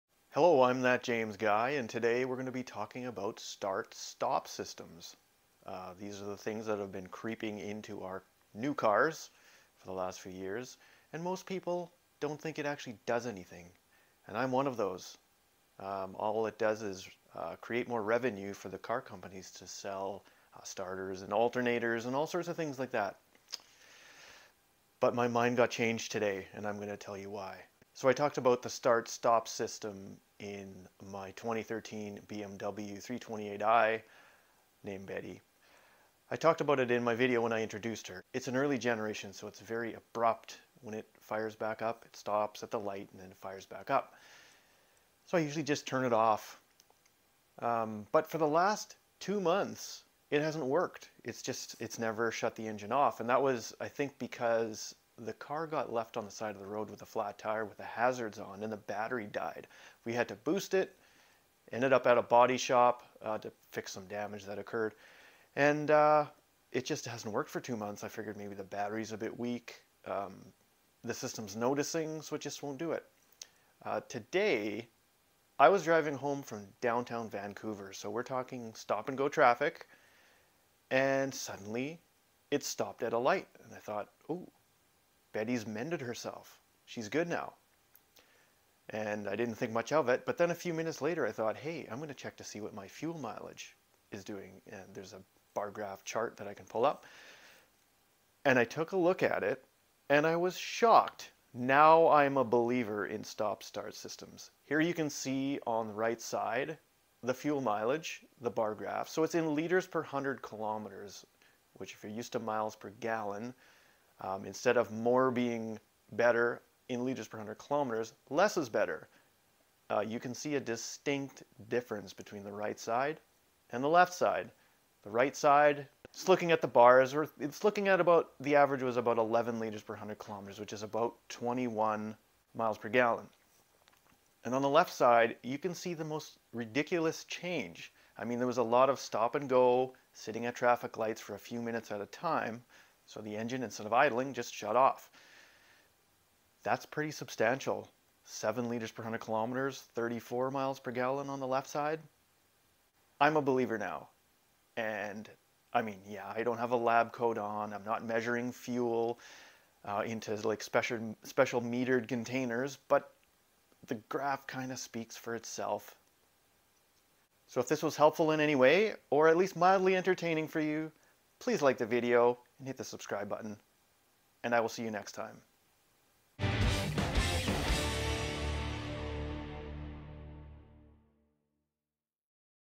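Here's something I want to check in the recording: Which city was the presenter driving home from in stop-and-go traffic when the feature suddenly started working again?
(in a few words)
Vancouver.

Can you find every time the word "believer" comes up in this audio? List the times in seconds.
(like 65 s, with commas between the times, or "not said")
102 s, 153 s.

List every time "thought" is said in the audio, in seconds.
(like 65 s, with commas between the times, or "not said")
83 s, 91 s.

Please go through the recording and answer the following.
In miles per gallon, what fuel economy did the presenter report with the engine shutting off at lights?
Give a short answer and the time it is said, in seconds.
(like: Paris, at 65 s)
34 miles per gallon, at 149 s.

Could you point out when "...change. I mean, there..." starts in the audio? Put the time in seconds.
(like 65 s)
137 s.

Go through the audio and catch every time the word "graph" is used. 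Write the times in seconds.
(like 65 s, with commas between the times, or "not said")
95 s, 108 s, 164 s.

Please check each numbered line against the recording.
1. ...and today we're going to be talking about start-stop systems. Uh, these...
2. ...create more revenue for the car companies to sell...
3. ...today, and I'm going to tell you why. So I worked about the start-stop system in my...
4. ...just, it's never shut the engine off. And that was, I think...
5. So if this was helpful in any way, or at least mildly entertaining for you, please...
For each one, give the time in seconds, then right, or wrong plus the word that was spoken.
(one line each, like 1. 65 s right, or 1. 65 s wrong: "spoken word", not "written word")
1. 1 s right
2. 17 s right
3. 26 s wrong: "talked", not "worked"
4. 51 s right
5. 167 s right.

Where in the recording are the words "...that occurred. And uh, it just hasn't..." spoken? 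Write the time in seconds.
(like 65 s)
64 s.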